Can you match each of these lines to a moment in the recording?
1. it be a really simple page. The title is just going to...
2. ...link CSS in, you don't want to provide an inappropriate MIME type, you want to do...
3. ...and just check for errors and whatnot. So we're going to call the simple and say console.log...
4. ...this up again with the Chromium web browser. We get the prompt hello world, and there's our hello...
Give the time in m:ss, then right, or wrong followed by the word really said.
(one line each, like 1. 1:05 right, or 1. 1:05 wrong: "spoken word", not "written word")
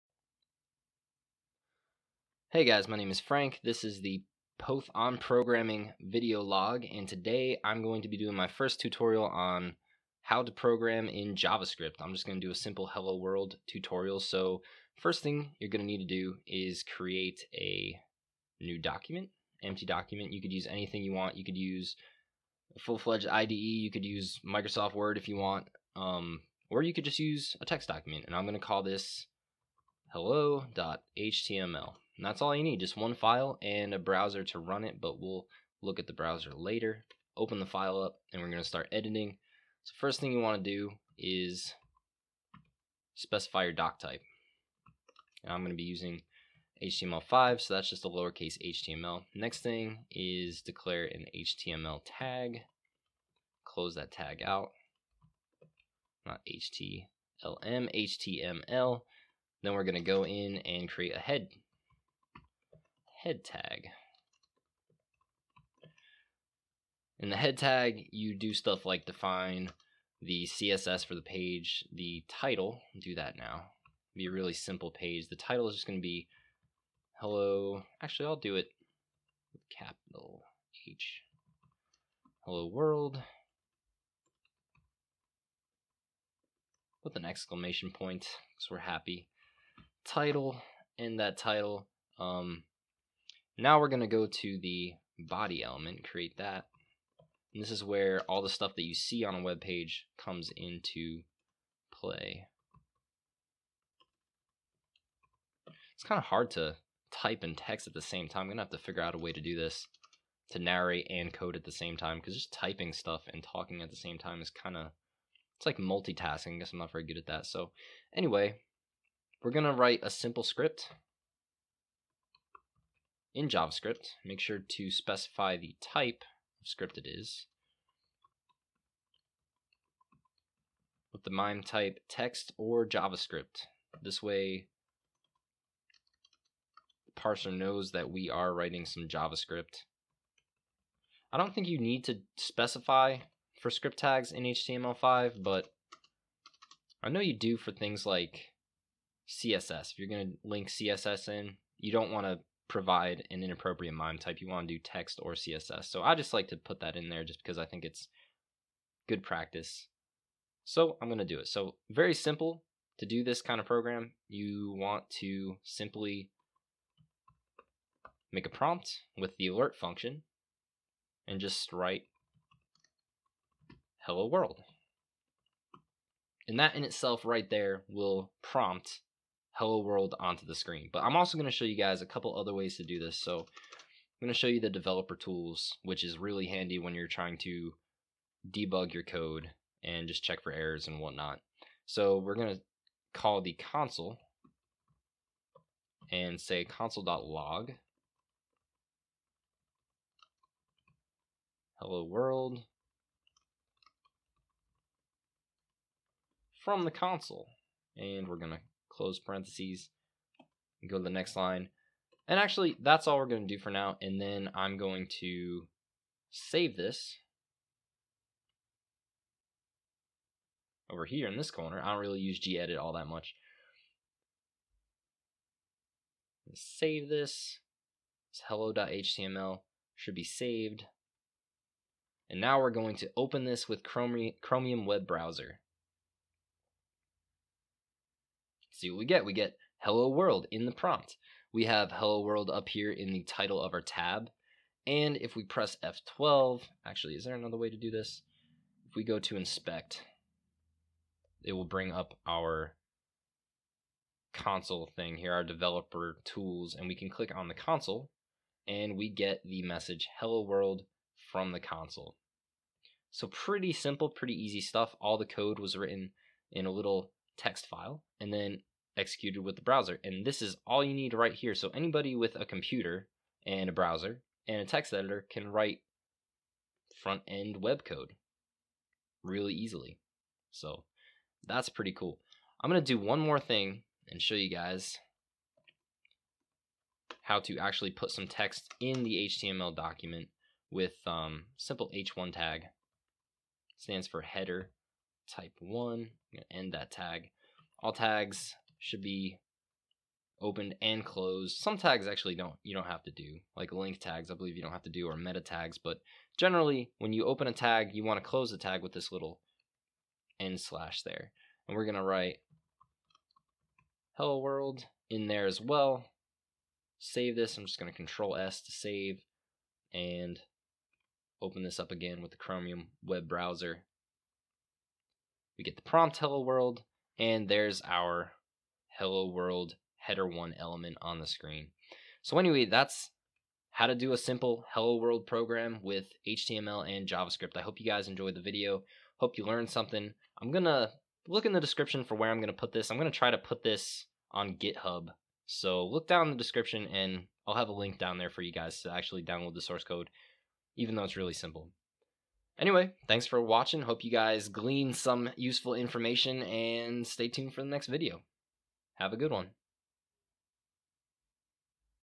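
1. 1:14 right
2. 2:30 right
3. 3:09 wrong: "console", not "simple"
4. 5:21 right.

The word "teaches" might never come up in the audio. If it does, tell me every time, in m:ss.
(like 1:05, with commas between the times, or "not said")
not said.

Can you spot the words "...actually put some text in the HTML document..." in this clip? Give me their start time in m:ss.
4:47.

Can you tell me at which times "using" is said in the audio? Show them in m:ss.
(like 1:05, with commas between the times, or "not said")
0:45.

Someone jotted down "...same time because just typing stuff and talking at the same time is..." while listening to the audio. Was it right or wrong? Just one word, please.
right.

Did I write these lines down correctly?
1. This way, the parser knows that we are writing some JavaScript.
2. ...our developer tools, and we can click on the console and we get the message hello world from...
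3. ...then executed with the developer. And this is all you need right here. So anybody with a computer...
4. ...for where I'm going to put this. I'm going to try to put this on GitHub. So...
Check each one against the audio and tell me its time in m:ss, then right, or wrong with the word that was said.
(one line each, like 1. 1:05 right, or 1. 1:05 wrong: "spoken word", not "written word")
1. 2:14 right
2. 4:15 right
3. 4:28 wrong: "browser", not "developer"
4. 5:42 right.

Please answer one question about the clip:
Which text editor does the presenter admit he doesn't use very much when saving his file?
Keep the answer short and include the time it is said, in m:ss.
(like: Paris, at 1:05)
gedit, at 3:42.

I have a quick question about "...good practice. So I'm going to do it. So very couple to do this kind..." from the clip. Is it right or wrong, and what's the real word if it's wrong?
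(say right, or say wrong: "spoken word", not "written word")
wrong: "simple", not "couple".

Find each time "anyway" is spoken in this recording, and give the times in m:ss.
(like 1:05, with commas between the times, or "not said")
1:58, 5:32, 5:52.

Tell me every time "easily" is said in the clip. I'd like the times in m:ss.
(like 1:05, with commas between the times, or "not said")
4:39.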